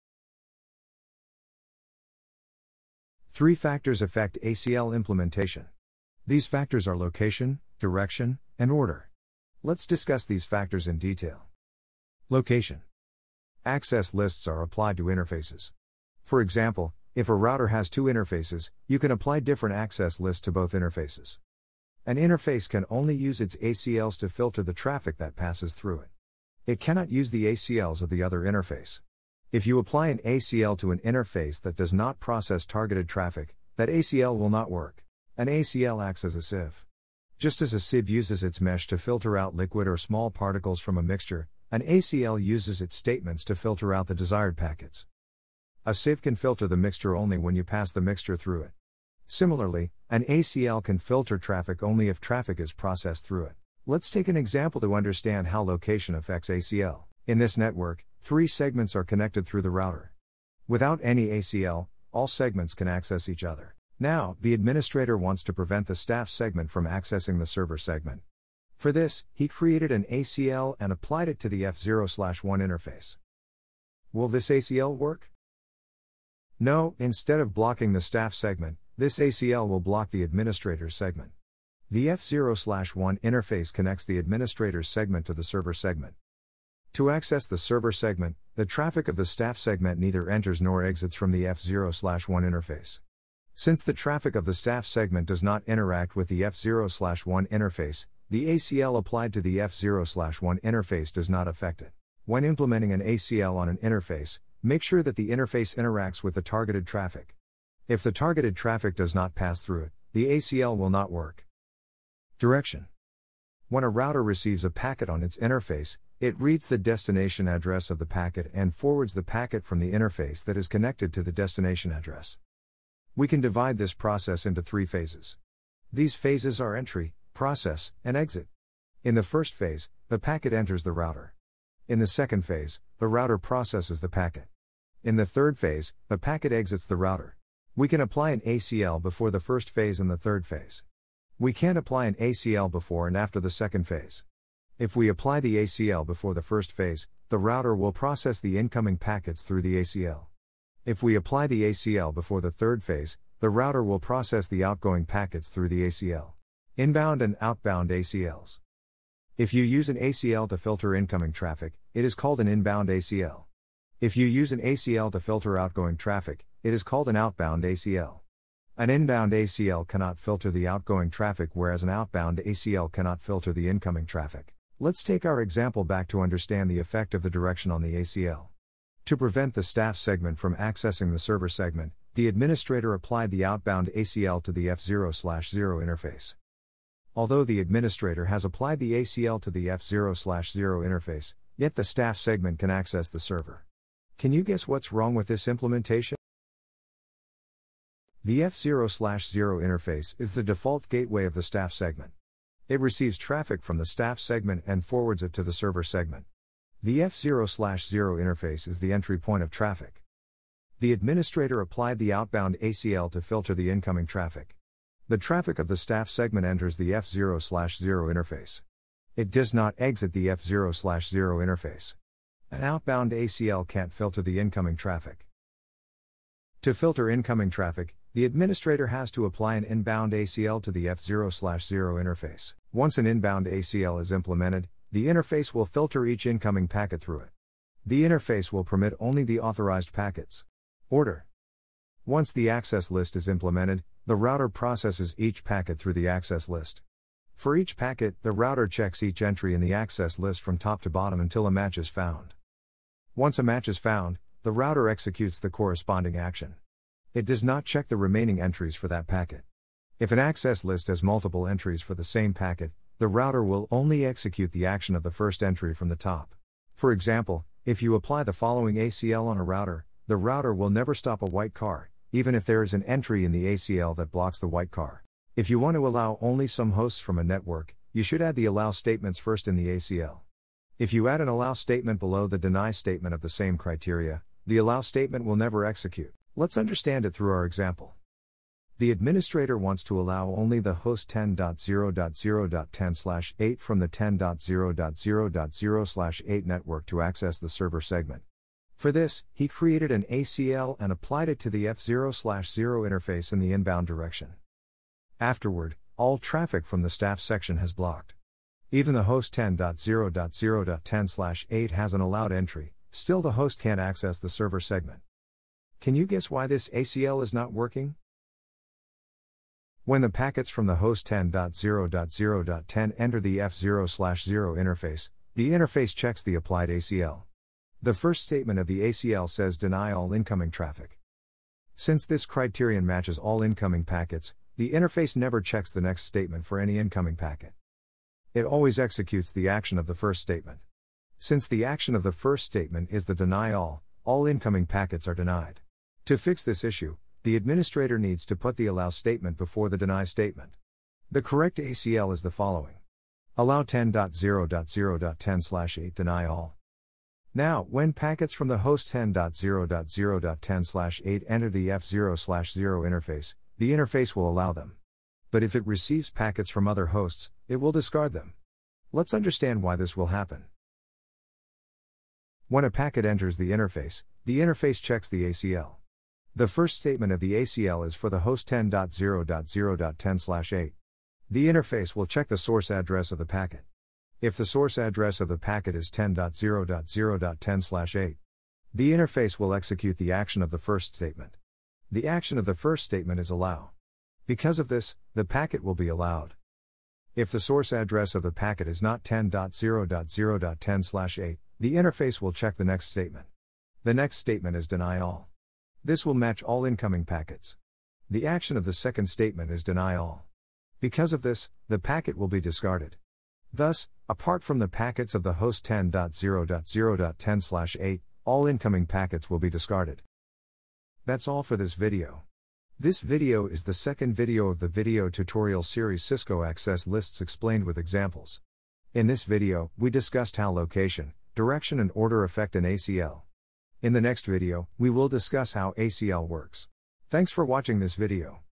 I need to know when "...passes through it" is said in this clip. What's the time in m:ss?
0:25.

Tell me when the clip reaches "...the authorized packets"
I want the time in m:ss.
3:59.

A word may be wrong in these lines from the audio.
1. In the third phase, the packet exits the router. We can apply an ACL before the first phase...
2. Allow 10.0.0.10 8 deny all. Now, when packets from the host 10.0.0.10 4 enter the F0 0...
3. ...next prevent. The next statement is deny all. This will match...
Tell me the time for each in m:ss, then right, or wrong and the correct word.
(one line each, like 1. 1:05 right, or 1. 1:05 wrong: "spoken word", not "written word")
1. 2:15 right
2. 5:53 wrong: "8", not "4"
3. 6:42 wrong: "statement", not "prevent".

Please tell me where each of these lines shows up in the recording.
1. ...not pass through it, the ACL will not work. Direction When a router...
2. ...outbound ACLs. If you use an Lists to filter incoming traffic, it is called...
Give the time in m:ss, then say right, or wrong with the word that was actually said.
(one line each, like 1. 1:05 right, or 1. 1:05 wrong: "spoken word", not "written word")
1. 1:49 right
2. 2:37 wrong: "ACL", not "Lists".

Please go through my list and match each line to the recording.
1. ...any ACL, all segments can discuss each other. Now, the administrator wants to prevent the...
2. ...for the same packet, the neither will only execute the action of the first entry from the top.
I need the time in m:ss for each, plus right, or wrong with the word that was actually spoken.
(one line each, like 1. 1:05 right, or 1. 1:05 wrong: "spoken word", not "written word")
1. 1:01 wrong: "access", not "discuss"
2. 4:21 wrong: "router", not "neither".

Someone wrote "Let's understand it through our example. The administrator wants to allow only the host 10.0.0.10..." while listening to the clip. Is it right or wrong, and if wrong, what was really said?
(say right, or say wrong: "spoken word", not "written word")
right.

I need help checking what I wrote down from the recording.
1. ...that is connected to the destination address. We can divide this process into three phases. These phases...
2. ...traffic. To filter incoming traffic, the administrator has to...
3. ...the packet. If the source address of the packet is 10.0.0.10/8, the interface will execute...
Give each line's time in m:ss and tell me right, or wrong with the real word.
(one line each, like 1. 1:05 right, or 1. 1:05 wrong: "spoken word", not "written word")
1. 2:00 right
2. 3:44 right
3. 6:23 right.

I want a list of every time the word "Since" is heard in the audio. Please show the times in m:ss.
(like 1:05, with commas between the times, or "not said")
1:33, 5:31, 5:41.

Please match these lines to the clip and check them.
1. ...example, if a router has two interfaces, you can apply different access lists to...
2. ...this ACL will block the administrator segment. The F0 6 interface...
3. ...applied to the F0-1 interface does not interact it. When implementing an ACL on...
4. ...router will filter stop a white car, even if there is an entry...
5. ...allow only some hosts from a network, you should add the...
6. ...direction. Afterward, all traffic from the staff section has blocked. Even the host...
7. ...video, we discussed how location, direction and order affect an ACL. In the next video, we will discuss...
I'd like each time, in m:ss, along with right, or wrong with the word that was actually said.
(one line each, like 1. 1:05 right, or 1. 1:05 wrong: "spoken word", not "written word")
1. 0:16 right
2. 1:18 wrong: "1", not "6"
3. 1:38 wrong: "affect", not "interact"
4. 4:30 wrong: "never", not "filter"
5. 4:35 right
6. 5:03 right
7. 7:09 right.